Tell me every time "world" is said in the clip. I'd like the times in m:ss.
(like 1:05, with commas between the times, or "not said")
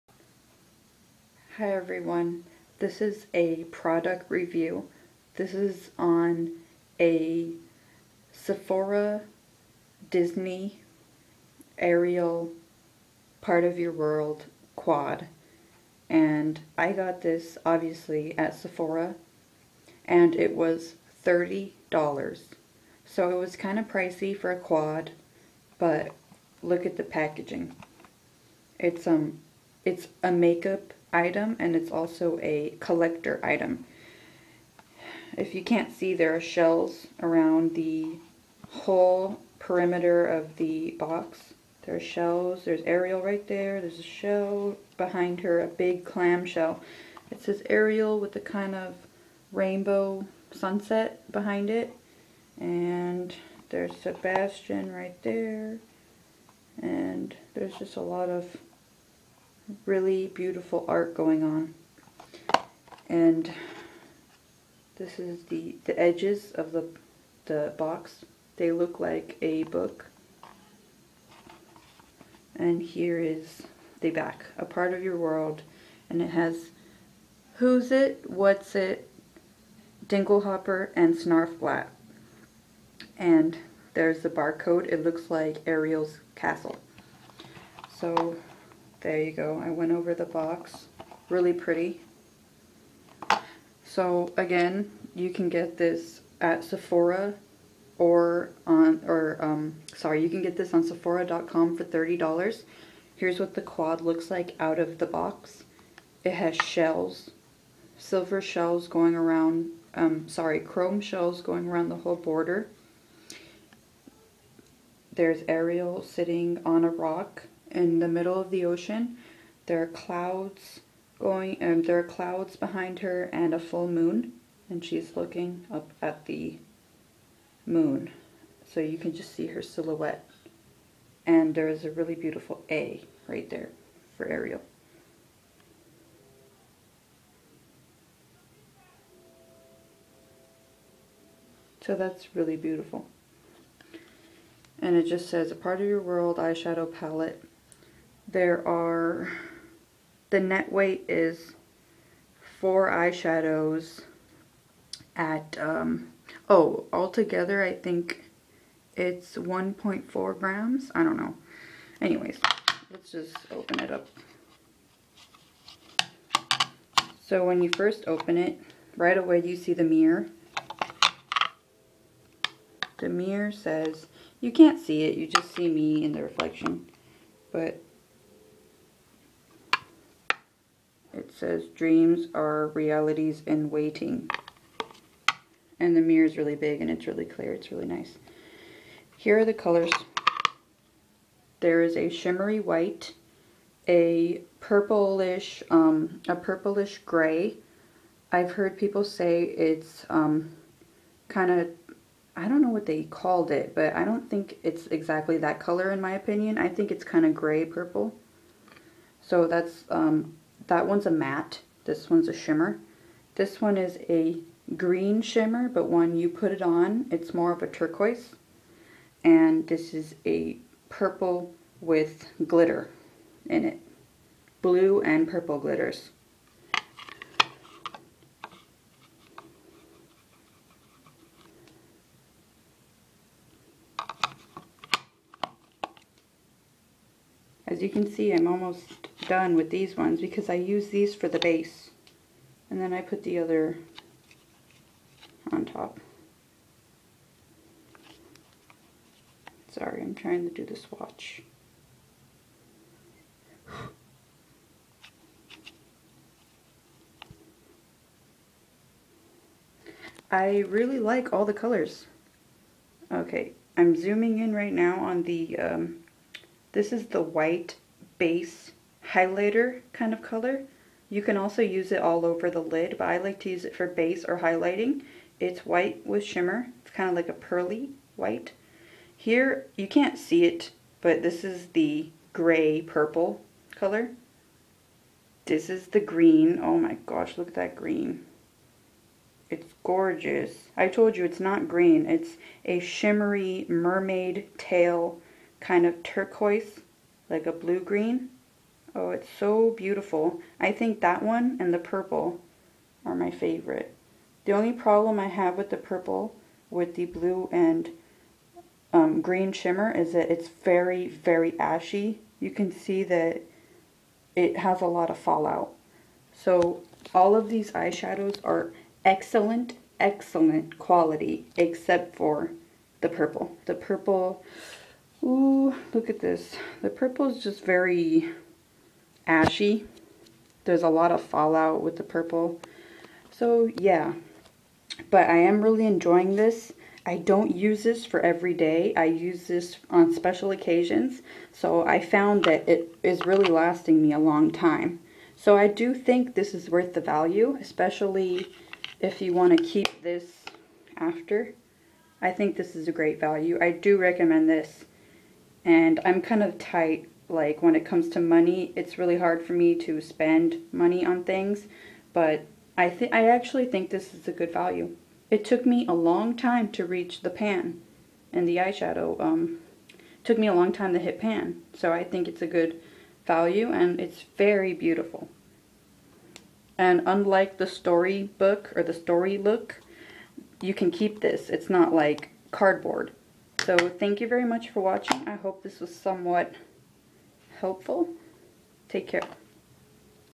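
0:13, 1:15, 2:26.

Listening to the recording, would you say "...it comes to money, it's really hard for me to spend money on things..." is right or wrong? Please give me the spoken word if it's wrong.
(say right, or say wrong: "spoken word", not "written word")
right.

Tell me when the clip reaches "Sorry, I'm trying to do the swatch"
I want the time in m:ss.
4:09.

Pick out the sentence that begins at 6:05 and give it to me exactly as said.
It took me a long time to reach the pan and the eyeshadow.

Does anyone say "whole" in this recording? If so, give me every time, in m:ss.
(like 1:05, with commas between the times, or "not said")
0:38, 1:51.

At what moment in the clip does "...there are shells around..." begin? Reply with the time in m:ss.
0:36.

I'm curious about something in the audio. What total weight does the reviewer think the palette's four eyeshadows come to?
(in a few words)
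1.4 grams.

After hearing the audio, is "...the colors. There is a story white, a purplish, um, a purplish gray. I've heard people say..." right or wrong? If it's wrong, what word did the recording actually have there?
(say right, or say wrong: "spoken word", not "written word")
wrong: "shimmery", not "story".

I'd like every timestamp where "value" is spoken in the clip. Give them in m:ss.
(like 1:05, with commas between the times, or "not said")
5:47, 5:53, 6:04, 6:13.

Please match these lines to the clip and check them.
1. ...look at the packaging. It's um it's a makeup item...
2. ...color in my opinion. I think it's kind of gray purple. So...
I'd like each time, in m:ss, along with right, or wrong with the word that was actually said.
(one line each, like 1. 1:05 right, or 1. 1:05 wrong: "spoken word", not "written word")
1. 0:26 right
2. 3:25 right.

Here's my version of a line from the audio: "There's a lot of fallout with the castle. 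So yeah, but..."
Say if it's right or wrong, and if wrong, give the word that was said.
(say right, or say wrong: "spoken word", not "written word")
wrong: "purple", not "castle".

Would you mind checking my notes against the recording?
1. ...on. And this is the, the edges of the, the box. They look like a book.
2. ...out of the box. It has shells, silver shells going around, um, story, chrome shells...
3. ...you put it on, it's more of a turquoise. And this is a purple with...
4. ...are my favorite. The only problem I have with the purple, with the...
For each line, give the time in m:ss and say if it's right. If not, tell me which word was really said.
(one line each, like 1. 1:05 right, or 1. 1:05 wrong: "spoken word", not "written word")
1. 1:01 right
2. 1:44 wrong: "sorry", not "story"
3. 3:36 right
4. 5:03 right.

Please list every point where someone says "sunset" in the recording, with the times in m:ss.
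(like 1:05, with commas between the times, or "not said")
0:50.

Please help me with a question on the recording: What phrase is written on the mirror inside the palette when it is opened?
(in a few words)
dreams are realities in waiting.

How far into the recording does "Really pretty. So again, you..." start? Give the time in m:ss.
1:31.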